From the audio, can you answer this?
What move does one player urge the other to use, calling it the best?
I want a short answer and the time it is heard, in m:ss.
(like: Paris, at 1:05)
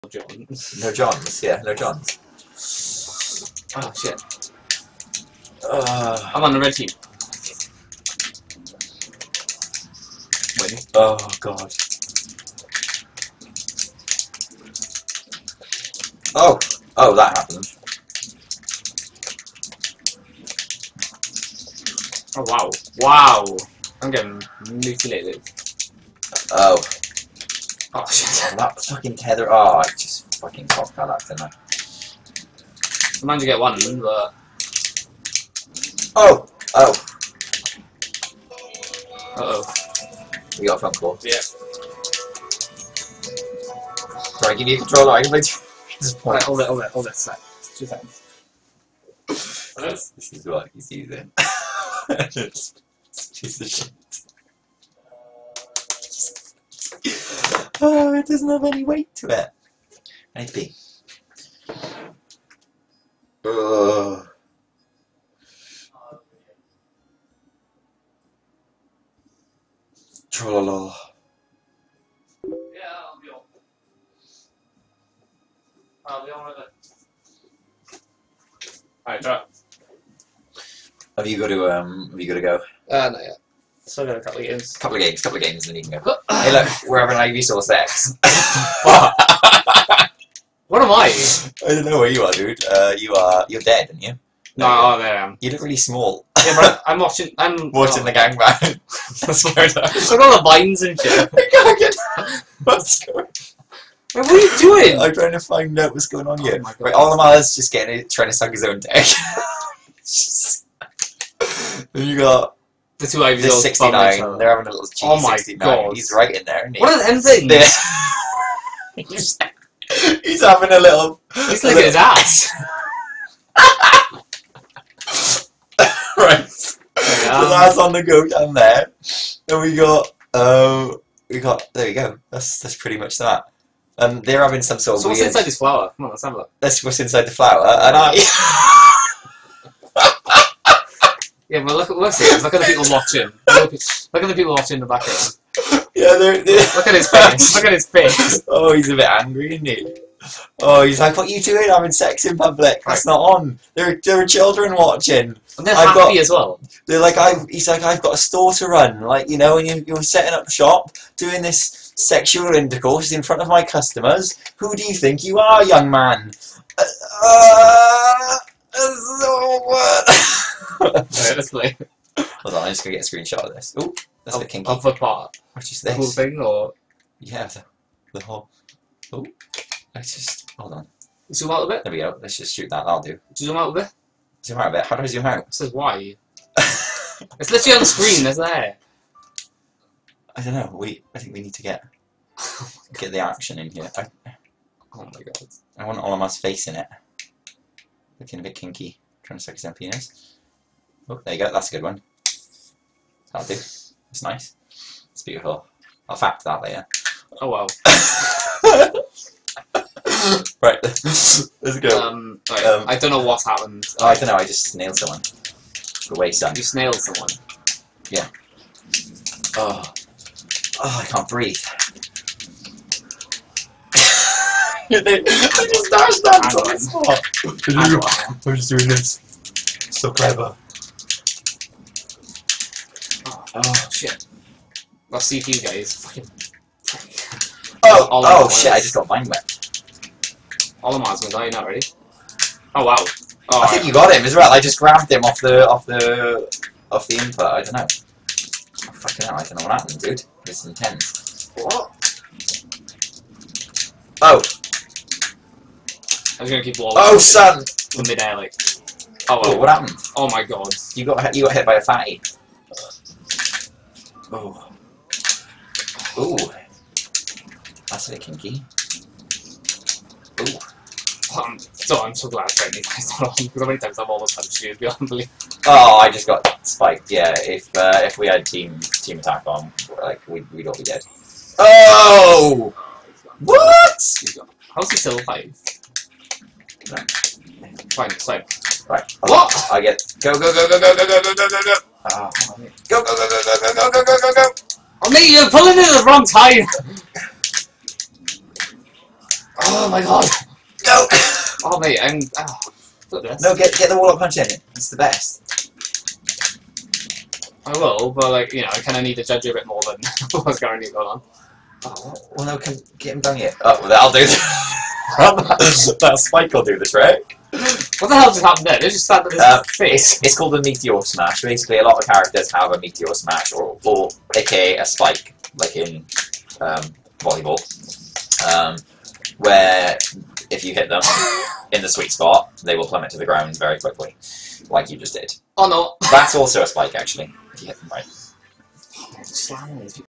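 Wall punch, at 5:03.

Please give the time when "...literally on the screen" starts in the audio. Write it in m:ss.
3:07.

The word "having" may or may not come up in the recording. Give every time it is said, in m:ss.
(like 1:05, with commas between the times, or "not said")
1:26, 1:54, 2:00, 2:14, 2:31.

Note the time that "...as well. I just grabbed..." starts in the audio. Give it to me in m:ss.
4:04.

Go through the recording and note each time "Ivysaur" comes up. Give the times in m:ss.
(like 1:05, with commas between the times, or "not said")
1:27, 1:53.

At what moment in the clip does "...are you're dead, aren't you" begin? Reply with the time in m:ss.
1:33.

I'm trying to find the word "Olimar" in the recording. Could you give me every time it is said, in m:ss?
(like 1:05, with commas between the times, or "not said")
1:46, 3:15.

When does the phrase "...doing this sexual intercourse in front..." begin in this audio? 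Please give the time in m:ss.
2:41.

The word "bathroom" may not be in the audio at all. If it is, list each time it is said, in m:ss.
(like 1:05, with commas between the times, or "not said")
not said.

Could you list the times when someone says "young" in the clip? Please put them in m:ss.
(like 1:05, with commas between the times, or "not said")
2:45.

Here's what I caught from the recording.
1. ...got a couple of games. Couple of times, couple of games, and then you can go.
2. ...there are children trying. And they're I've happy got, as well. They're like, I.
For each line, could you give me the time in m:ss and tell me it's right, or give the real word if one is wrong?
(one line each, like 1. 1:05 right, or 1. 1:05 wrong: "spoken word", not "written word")
1. 1:24 wrong: "games", not "times"
2. 2:34 wrong: "watching", not "trying".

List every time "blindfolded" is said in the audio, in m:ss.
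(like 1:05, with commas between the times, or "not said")
not said.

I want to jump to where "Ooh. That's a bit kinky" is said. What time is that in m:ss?
4:26.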